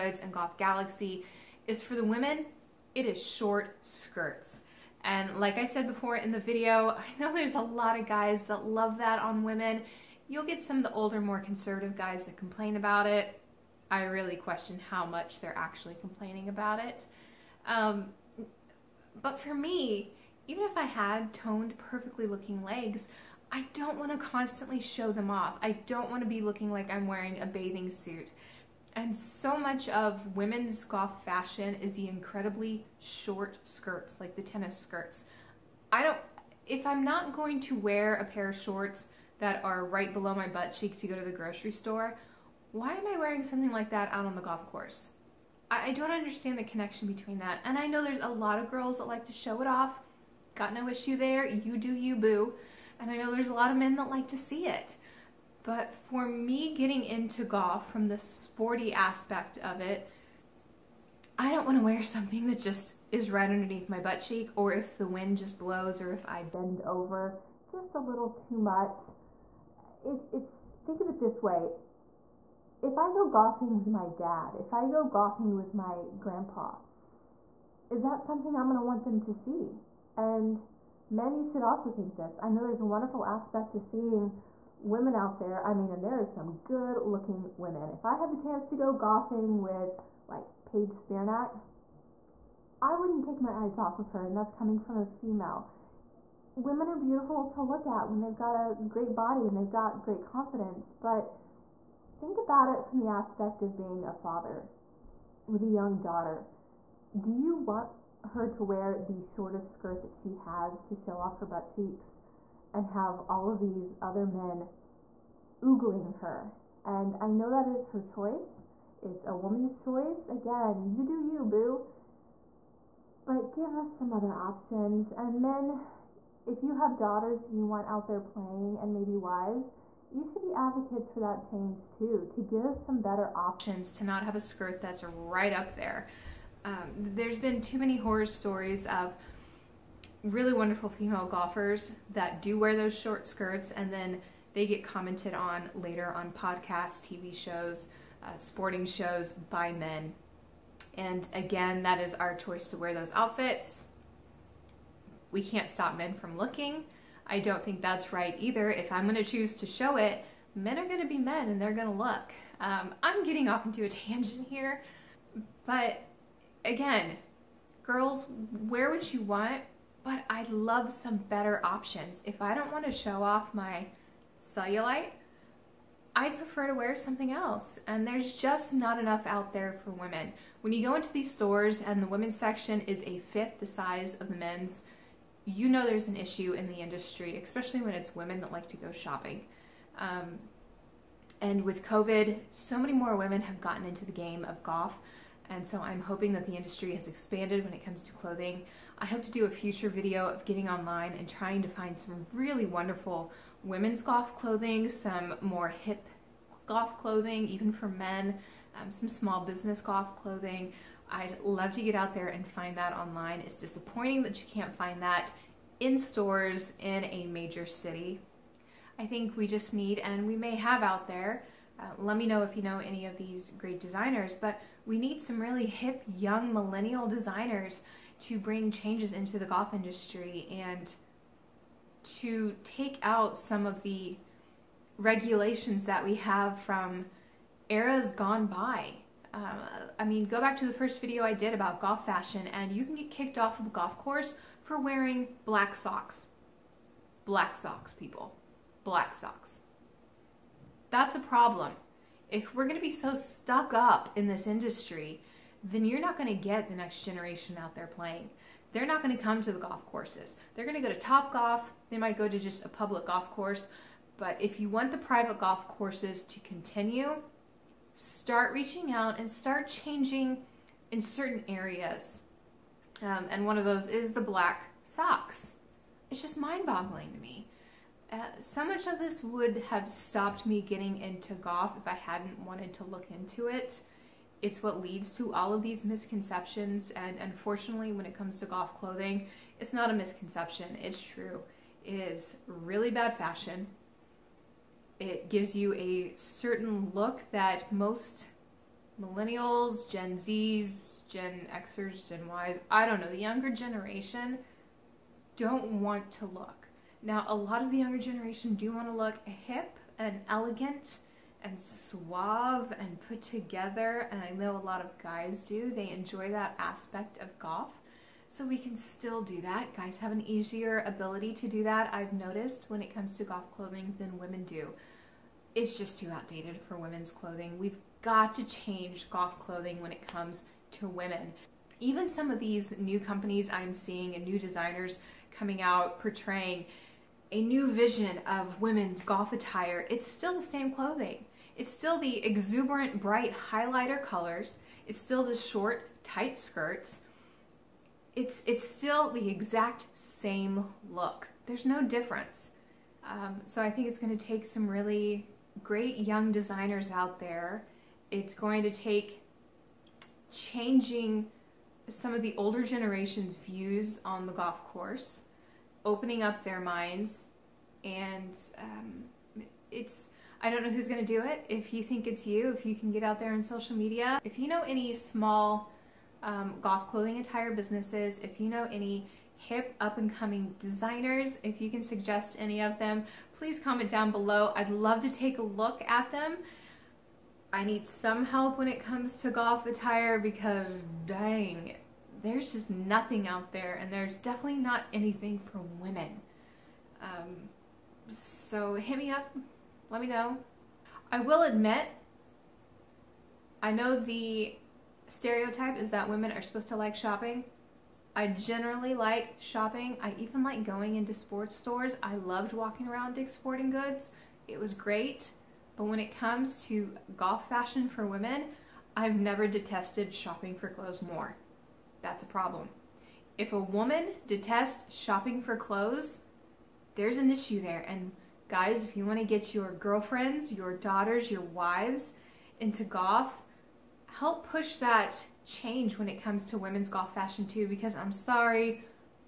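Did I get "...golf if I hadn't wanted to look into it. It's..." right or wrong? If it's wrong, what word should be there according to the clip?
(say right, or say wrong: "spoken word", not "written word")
right.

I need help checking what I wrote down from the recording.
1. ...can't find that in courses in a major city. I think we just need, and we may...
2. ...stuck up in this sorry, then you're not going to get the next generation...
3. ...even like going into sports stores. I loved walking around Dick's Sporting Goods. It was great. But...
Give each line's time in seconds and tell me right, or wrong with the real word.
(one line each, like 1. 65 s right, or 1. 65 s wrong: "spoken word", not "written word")
1. 214 s wrong: "stores", not "courses"
2. 253 s wrong: "industry", not "sorry"
3. 410 s right.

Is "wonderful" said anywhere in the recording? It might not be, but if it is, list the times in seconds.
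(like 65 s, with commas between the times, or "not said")
82 s, 140 s, 202 s.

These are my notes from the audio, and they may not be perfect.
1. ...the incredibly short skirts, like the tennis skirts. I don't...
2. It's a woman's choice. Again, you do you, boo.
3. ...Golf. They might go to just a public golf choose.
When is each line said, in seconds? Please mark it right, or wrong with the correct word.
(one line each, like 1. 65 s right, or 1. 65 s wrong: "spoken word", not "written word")
1. 31 s right
2. 119 s right
3. 261 s wrong: "course", not "choose".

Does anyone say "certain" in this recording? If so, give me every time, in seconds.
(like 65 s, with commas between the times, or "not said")
271 s, 296 s.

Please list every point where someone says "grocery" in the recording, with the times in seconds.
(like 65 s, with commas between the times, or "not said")
41 s.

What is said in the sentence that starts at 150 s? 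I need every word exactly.
And again, that is our choice to wear those outfits.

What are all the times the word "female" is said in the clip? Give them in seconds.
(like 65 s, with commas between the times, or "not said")
95 s, 140 s.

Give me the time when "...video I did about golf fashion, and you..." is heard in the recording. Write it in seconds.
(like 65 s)
240 s.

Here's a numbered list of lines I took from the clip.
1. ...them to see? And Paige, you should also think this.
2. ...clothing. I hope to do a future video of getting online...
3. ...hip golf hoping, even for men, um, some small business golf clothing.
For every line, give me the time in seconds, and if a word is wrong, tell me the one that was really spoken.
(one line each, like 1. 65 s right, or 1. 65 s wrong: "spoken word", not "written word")
1. 79 s wrong: "Men", not "Paige"
2. 198 s right
3. 205 s wrong: "clothing", not "hoping".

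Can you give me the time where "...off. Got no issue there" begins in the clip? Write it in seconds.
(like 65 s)
49 s.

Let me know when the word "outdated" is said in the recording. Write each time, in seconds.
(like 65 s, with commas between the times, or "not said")
326 s.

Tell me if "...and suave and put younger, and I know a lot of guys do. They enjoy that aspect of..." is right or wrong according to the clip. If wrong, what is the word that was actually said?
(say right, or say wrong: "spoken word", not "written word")
wrong: "together", not "younger".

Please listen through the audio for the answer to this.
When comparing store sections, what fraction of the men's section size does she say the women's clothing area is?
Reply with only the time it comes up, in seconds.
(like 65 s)
183 s.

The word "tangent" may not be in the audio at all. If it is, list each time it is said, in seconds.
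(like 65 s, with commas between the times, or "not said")
163 s.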